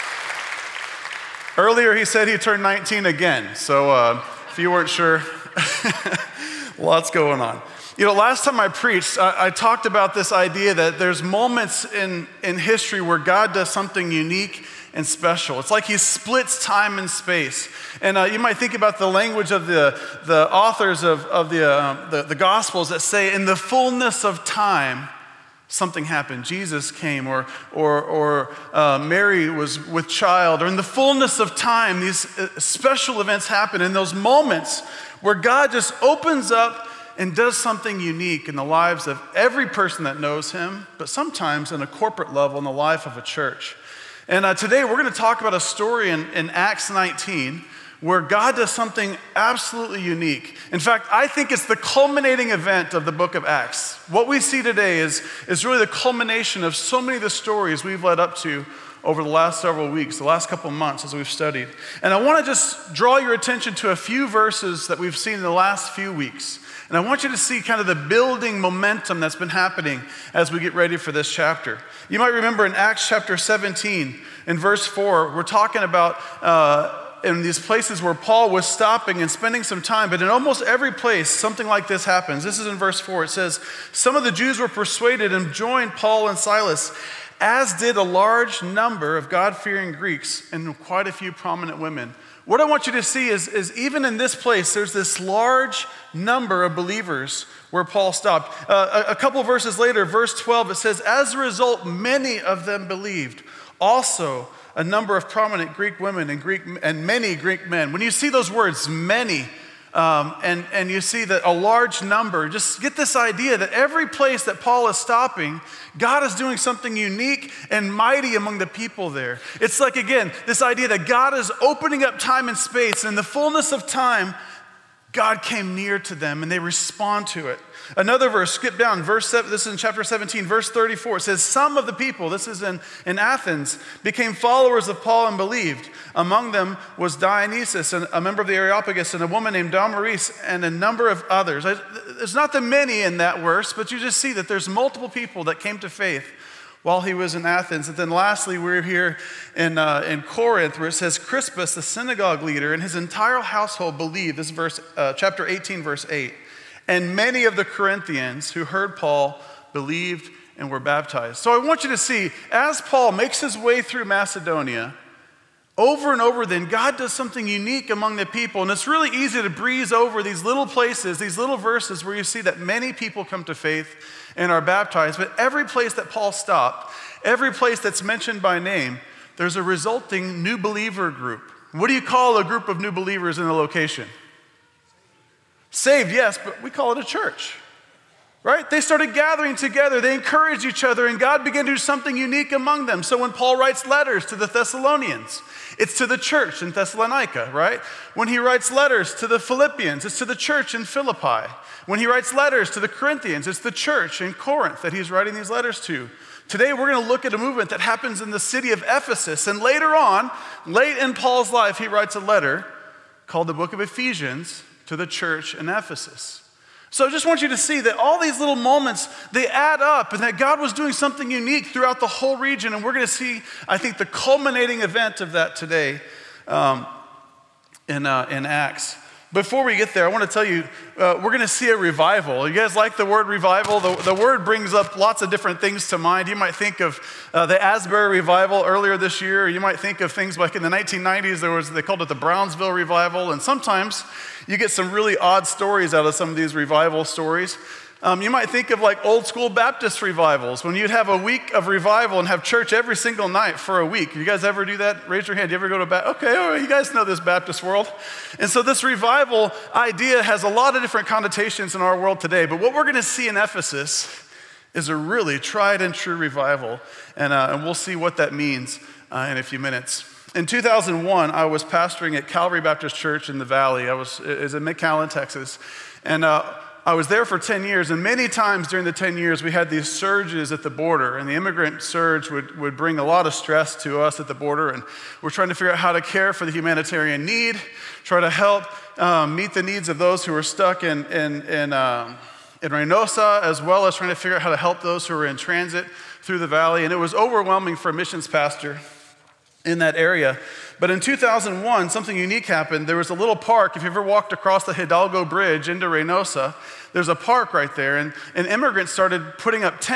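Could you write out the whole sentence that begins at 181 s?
What do you call a group of new believers in a location?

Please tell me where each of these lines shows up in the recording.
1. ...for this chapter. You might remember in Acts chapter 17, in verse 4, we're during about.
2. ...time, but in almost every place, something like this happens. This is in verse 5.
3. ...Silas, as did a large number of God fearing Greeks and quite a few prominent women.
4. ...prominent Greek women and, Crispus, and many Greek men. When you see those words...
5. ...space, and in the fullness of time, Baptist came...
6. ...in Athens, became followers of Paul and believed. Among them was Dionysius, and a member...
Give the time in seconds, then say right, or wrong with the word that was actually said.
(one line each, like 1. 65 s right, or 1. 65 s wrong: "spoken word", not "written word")
1. 70 s wrong: "talking", not "during"
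2. 79 s wrong: "4", not "5"
3. 86 s right
4. 105 s wrong: "Greek", not "Crispus"
5. 122 s wrong: "God", not "Baptist"
6. 133 s right.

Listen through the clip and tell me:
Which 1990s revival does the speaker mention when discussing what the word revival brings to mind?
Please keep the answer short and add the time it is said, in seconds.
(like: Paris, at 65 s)
Brownsville revival, at 242 s.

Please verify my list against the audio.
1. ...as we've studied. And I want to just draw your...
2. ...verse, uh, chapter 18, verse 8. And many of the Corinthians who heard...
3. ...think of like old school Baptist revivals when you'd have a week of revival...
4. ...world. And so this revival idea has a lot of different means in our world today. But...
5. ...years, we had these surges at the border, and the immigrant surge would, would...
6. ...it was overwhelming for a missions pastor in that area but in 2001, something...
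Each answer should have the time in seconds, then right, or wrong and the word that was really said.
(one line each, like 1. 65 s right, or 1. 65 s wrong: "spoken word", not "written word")
1. 61 s right
2. 154 s right
3. 248 s right
4. 257 s wrong: "connotations", not "means"
5. 279 s right
6. 296 s right.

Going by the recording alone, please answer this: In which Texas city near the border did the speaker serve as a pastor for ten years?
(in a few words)
McAllen.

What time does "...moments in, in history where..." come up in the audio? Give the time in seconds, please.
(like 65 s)
11 s.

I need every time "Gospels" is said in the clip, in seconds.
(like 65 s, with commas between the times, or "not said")
22 s.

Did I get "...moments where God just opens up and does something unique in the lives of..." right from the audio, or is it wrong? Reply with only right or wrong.
right.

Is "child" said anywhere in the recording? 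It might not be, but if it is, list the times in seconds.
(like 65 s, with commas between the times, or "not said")
30 s.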